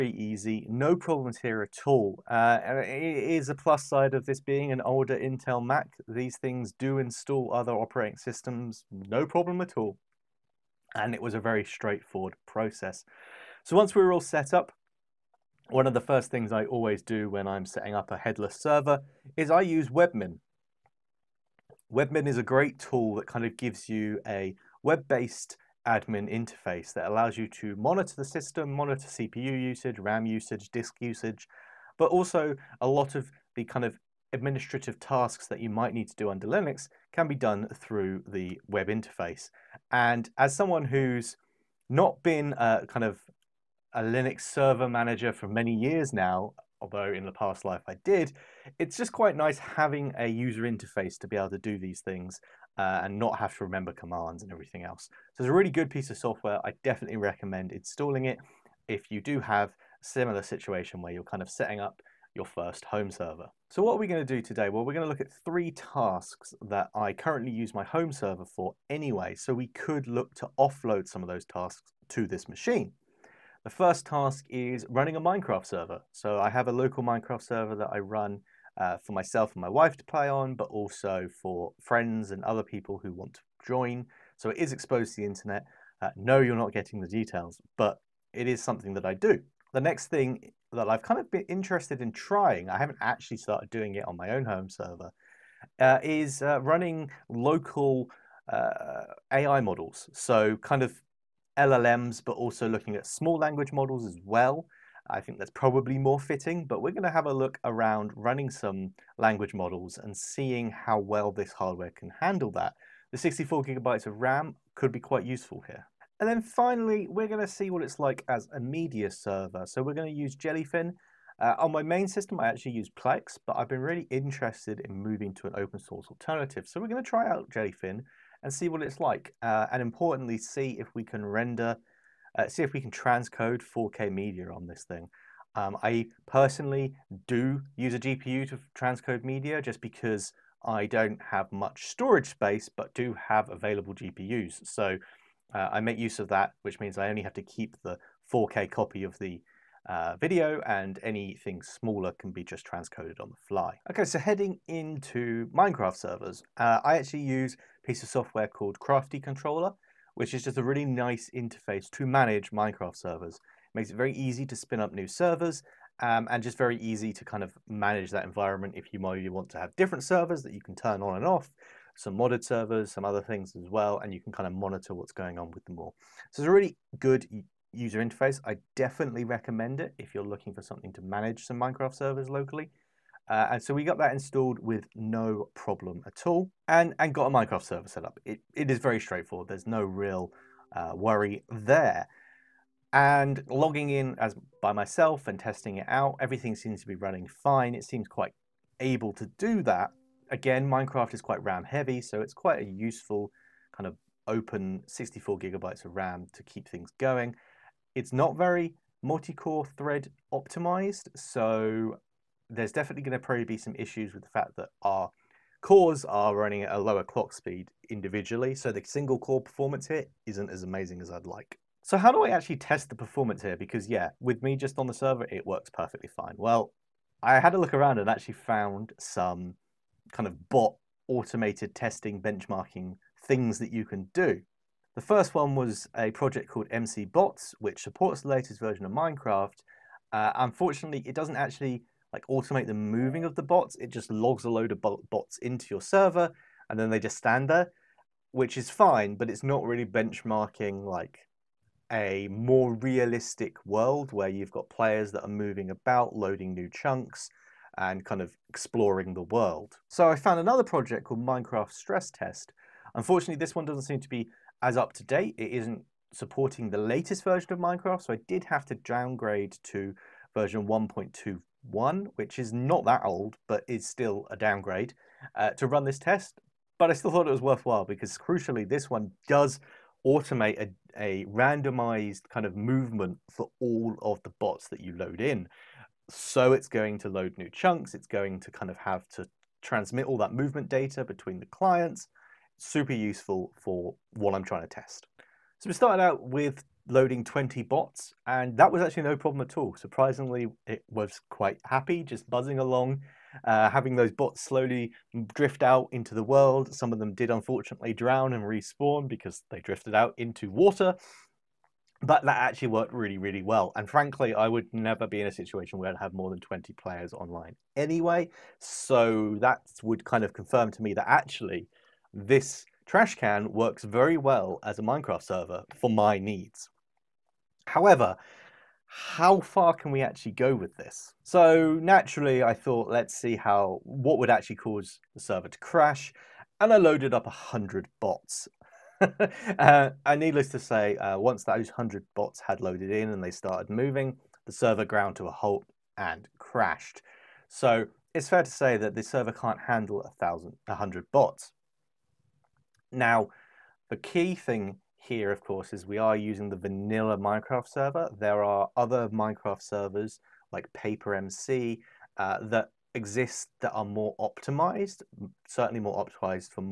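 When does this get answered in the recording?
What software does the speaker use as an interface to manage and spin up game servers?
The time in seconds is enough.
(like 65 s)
158 s.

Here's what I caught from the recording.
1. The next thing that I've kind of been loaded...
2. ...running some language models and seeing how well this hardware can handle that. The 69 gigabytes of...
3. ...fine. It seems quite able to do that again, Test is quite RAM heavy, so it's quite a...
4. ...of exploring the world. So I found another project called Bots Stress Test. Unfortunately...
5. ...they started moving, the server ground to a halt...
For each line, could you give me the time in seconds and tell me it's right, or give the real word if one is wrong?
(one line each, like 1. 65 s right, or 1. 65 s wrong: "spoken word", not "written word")
1. 89 s wrong: "interested", not "loaded"
2. 108 s wrong: "64", not "69"
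3. 197 s wrong: "Minecraft", not "Test"
4. 258 s wrong: "Minecraft", not "Bots"
5. 343 s right.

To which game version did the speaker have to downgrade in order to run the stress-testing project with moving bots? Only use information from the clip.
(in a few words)
1.21.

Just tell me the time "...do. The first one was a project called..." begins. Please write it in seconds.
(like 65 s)
234 s.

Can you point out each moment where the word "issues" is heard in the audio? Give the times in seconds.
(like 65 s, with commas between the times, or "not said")
213 s.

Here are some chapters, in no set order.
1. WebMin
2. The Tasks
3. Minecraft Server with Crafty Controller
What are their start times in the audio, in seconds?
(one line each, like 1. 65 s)
1. 21 s
2. 75 s
3. 154 s.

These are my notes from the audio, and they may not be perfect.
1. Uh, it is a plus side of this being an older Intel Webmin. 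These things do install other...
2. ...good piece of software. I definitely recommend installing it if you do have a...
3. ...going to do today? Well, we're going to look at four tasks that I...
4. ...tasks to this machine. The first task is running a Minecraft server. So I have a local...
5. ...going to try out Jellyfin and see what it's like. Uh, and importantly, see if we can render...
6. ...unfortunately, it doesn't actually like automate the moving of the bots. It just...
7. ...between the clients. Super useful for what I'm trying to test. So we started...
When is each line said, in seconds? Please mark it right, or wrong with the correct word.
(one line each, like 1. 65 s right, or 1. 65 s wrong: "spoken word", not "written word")
1. 2 s wrong: "Mac", not "Webmin"
2. 55 s right
3. 64 s wrong: "three", not "four"
4. 71 s right
5. 126 s right
6. 240 s right
7. 291 s right.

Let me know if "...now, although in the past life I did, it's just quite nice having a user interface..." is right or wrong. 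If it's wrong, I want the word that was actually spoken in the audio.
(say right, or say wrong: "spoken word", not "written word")
right.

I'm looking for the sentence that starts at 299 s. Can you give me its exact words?
Surprisingly, it was quite happy, just buzzing along, uh, having those bots slowly drift out into the world.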